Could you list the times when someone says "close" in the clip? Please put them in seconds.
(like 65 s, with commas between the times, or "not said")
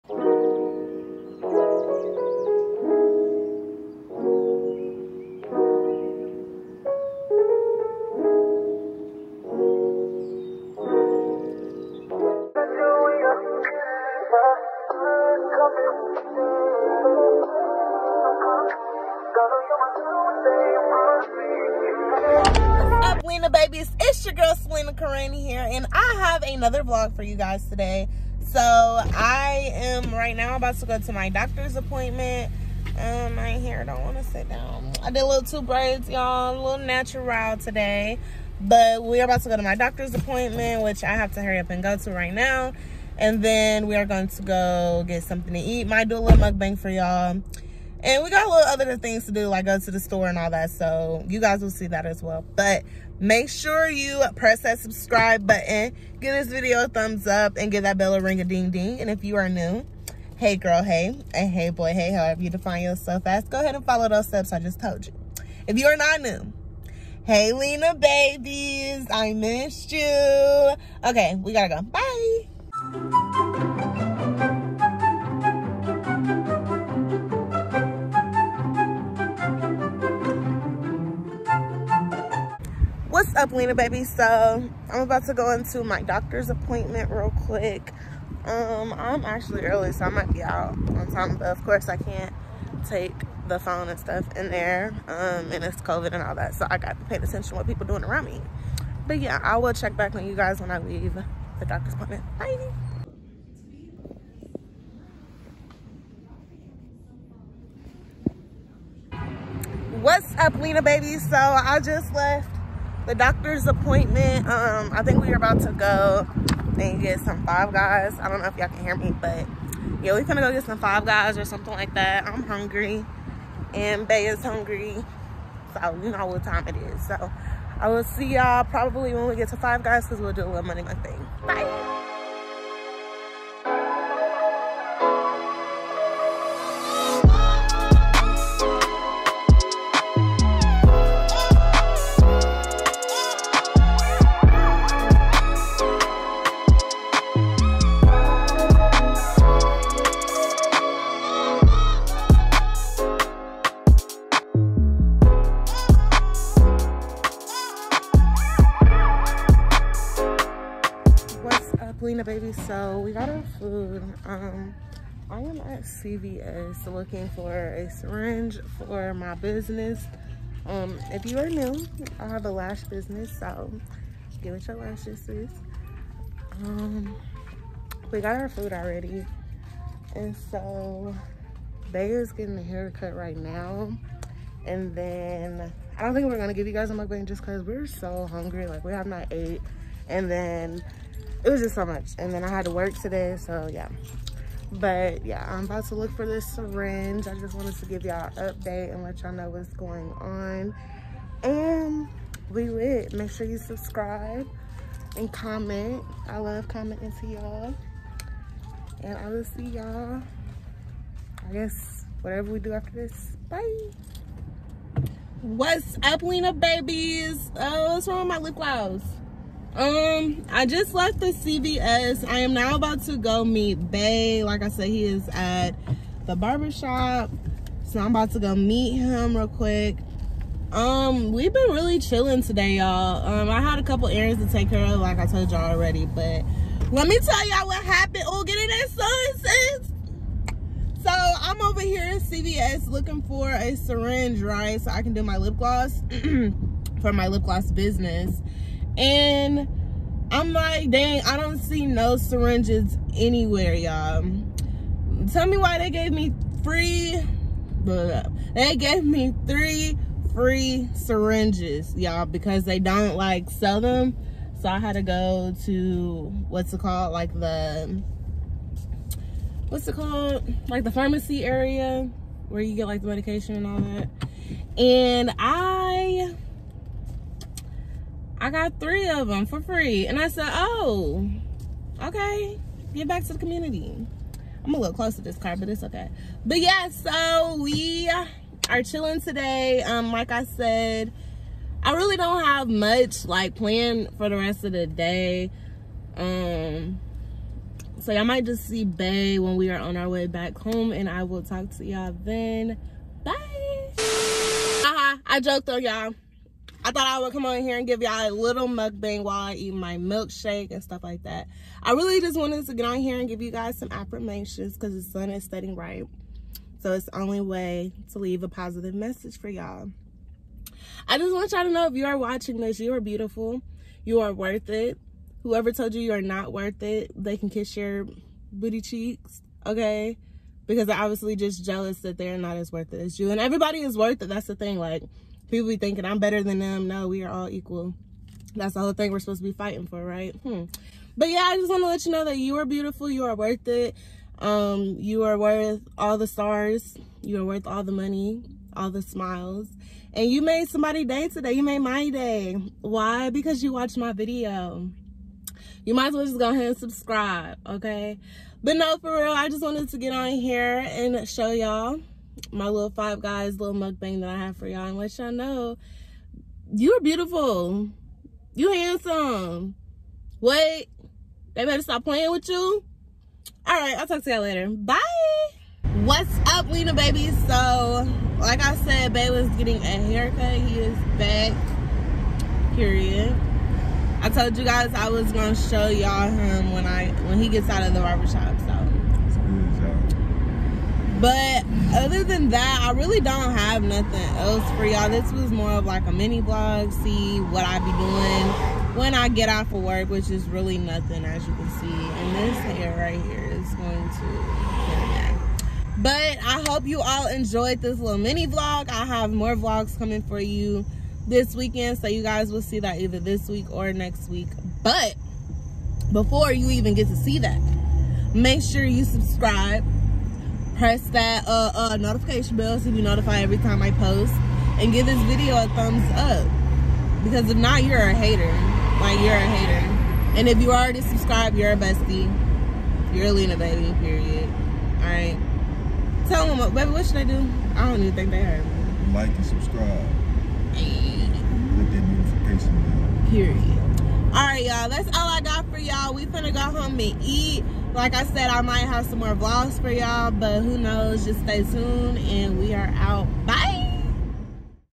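284 s.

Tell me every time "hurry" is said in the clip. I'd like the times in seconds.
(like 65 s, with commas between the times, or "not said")
41 s.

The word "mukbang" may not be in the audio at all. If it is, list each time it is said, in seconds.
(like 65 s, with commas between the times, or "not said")
46 s, 186 s, 308 s, 363 s.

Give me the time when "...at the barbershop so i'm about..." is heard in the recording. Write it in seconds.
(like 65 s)
225 s.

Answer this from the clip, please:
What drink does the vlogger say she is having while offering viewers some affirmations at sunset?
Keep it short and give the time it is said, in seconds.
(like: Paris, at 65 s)
milkshake, at 309 s.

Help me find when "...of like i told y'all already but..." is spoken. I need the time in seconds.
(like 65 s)
234 s.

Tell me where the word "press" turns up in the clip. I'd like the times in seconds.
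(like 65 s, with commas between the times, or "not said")
54 s, 420 s.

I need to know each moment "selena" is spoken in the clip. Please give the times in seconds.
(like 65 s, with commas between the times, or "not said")
24 s, 162 s.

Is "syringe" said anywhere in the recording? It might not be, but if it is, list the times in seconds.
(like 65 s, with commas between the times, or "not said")
167 s, 196 s, 243 s, 252 s, 260 s.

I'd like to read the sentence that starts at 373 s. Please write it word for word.
All right, I'll talk to y'all later.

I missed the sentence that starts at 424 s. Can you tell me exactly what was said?
And give this video a thumbs up.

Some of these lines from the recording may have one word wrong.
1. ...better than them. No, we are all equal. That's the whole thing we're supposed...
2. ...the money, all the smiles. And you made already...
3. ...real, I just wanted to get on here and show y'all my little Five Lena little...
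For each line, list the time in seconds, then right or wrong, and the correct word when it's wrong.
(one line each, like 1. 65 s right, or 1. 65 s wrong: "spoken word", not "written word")
1. 336 s right
2. 347 s wrong: "somebody", not "already"
3. 359 s wrong: "Guys", not "Lena".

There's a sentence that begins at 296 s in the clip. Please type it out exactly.
Um, so y'all might just see Bay when we are on our way back home and I will talk to y'all then.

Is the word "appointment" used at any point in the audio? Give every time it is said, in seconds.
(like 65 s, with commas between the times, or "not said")
31 s, 40 s, 86 s, 101 s, 113 s.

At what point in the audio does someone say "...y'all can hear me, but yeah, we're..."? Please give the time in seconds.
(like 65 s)
118 s.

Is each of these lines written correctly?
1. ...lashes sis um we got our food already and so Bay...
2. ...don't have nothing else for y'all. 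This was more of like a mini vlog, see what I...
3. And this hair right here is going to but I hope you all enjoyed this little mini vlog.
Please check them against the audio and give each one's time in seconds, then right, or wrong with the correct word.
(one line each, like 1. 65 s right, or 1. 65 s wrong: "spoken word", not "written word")
1. 174 s right
2. 393 s right
3. 401 s right.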